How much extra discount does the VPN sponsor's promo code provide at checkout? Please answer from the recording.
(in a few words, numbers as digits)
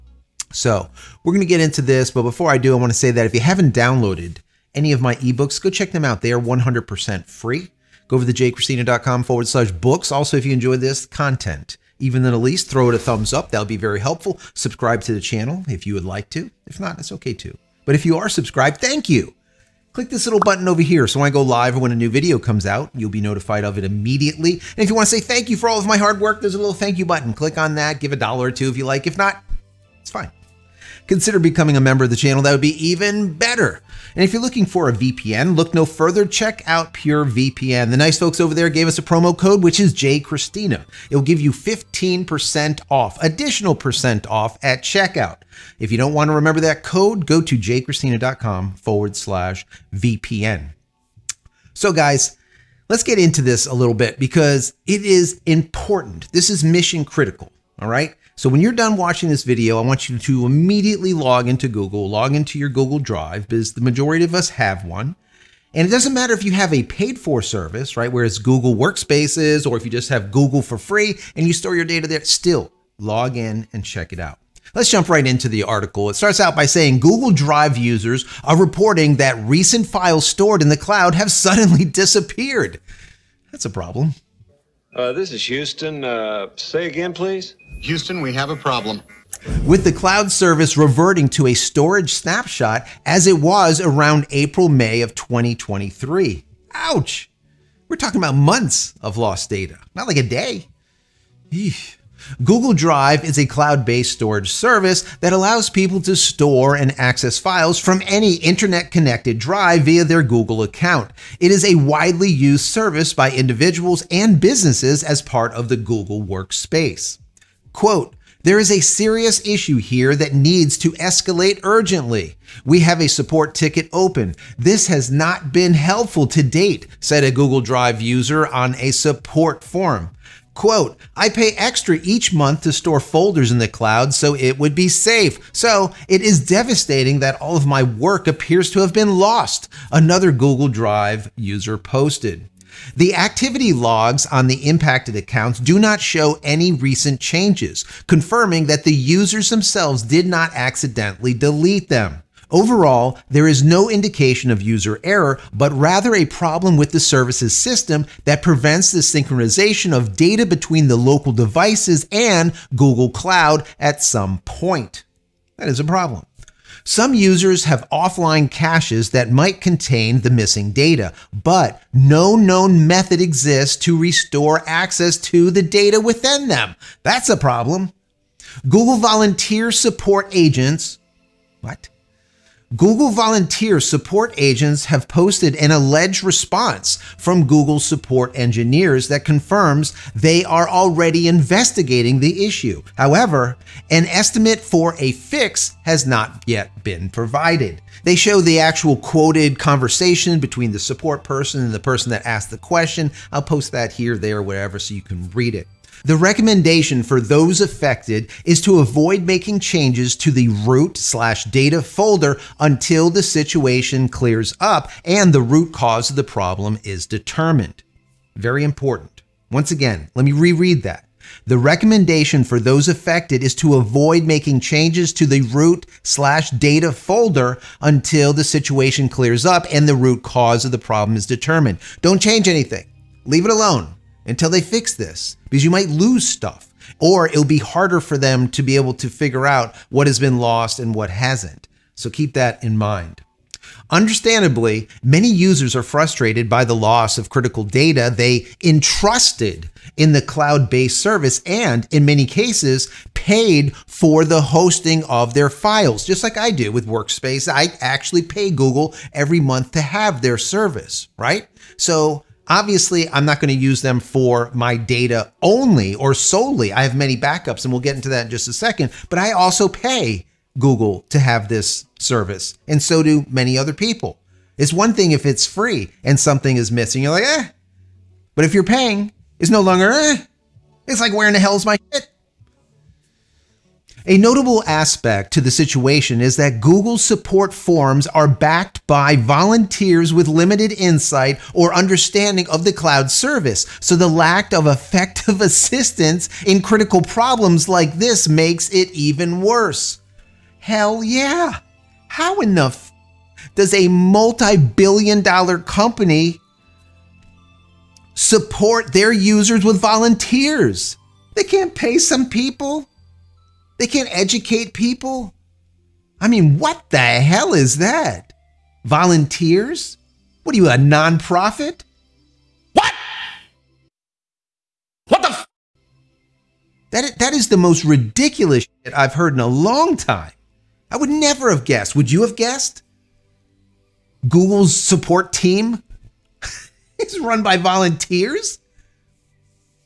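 15%.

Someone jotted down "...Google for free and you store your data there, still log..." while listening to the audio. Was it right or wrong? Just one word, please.
right.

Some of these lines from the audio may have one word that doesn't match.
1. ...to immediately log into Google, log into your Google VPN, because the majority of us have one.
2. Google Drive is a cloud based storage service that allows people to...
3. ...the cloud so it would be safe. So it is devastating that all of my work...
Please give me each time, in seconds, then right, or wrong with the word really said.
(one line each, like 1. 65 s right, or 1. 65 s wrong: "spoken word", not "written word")
1. 60 s wrong: "Drive", not "VPN"
2. 102 s right
3. 133 s right.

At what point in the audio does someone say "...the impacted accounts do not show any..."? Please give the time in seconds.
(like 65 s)
144 s.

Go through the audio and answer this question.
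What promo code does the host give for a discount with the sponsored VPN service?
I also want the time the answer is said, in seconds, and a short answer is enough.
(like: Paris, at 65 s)
JCristina, at 39 s.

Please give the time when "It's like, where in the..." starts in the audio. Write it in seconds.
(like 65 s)
280 s.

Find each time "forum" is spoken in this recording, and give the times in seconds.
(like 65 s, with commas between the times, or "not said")
129 s.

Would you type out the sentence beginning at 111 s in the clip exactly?
It is a widely used service by individuals and businesses as part of the Google Workspace.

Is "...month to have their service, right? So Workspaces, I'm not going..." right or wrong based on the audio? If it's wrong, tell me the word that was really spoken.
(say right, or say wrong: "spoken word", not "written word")
wrong: "Obviously", not "Workspaces".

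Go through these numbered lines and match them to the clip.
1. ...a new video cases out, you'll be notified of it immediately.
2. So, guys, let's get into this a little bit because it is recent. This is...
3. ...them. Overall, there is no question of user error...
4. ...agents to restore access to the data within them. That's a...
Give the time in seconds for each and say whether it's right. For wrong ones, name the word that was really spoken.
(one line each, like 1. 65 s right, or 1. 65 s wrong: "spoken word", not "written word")
1. 21 s wrong: "comes", not "cases"
2. 51 s wrong: "important", not "recent"
3. 151 s wrong: "indication", not "question"
4. 173 s wrong: "exists", not "agents".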